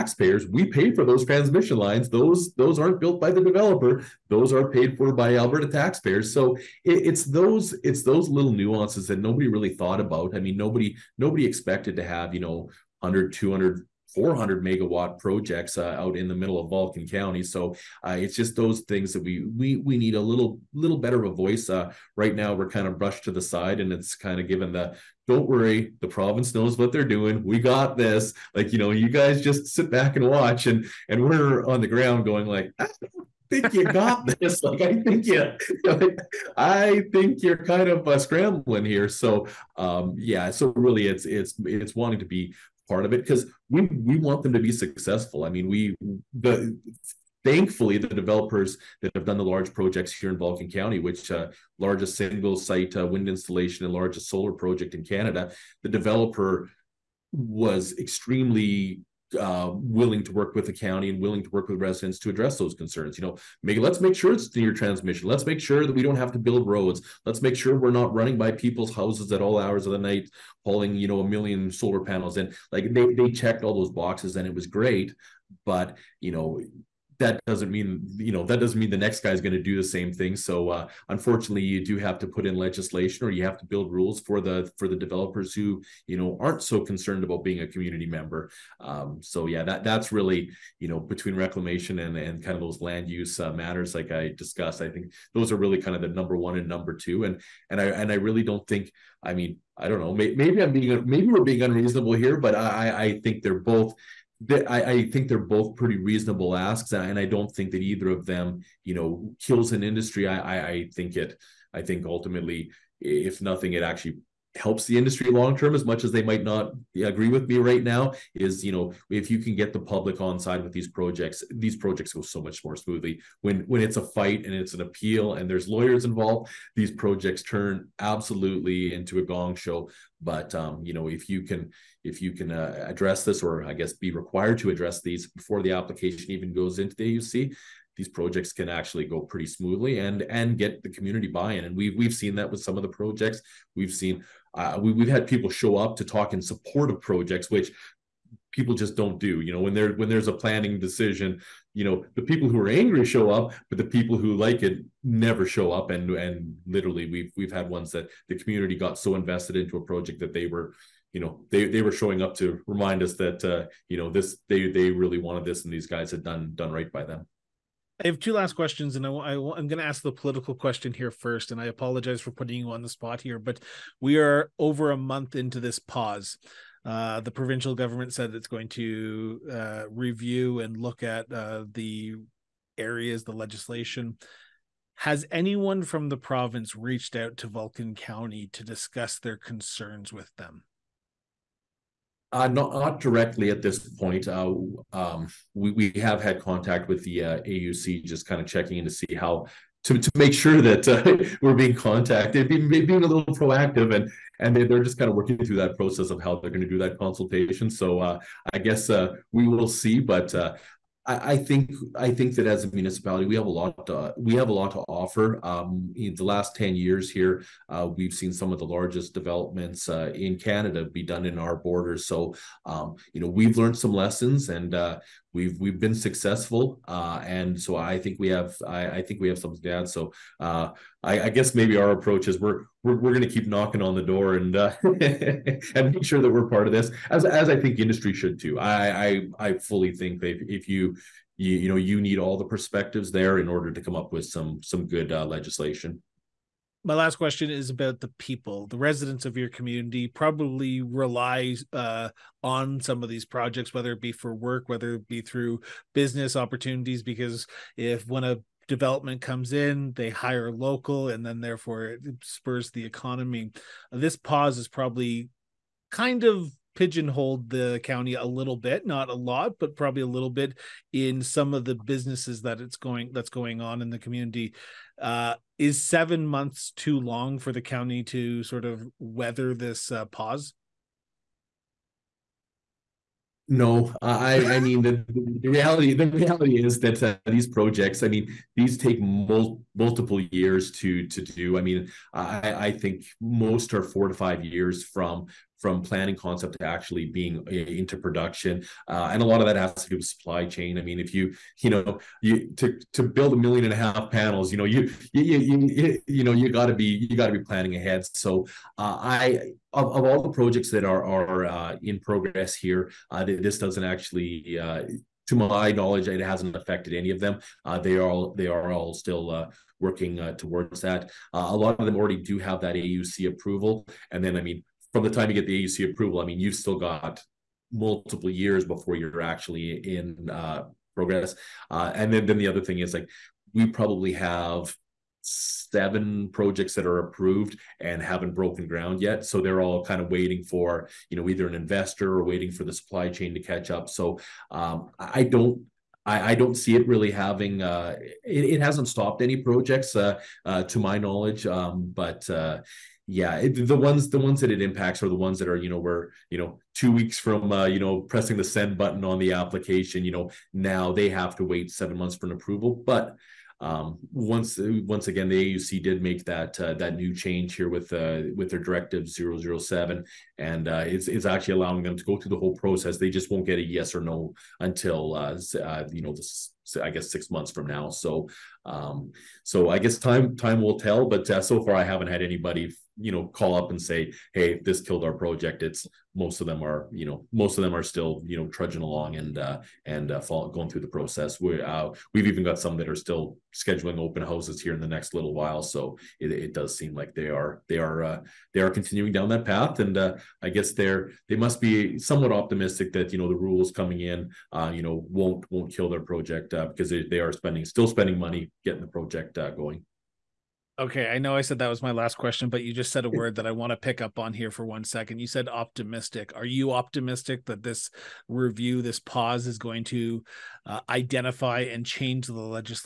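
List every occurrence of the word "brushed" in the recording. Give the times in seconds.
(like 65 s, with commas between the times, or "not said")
22 s.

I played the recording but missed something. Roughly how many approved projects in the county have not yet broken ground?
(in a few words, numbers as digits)
7.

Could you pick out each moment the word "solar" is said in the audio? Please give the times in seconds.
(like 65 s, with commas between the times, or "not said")
54 s, 71 s.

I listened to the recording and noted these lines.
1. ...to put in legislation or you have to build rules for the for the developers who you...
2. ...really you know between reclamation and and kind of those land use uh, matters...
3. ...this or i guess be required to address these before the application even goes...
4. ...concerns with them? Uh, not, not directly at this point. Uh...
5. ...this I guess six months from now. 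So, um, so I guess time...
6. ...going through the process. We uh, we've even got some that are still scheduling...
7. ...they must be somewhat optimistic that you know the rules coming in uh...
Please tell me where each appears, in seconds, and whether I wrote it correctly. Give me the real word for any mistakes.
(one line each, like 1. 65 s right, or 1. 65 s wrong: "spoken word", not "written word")
1. 82 s right
2. 90 s right
3. 133 s right
4. 189 s right
5. 376 s right
6. 390 s right
7. 401 s right.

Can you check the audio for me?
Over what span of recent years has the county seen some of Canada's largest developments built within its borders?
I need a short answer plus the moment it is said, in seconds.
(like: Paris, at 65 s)
10 years, at 216 s.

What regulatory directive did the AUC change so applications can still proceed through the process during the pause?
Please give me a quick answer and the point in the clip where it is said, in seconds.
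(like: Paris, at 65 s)
Directive 007, at 368 s.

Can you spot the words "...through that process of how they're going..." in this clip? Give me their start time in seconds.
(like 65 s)
205 s.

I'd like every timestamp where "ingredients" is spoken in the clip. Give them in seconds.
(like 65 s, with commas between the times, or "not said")
not said.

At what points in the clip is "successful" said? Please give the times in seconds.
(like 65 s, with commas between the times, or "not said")
44 s, 225 s.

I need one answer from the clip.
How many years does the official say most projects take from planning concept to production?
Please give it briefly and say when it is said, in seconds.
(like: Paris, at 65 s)
4 to 5 years, at 293 s.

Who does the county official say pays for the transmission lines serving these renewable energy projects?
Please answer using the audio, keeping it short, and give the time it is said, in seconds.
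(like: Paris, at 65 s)
Alberta taxpayers, at 5 s.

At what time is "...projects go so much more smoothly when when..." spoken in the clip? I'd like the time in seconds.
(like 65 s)
121 s.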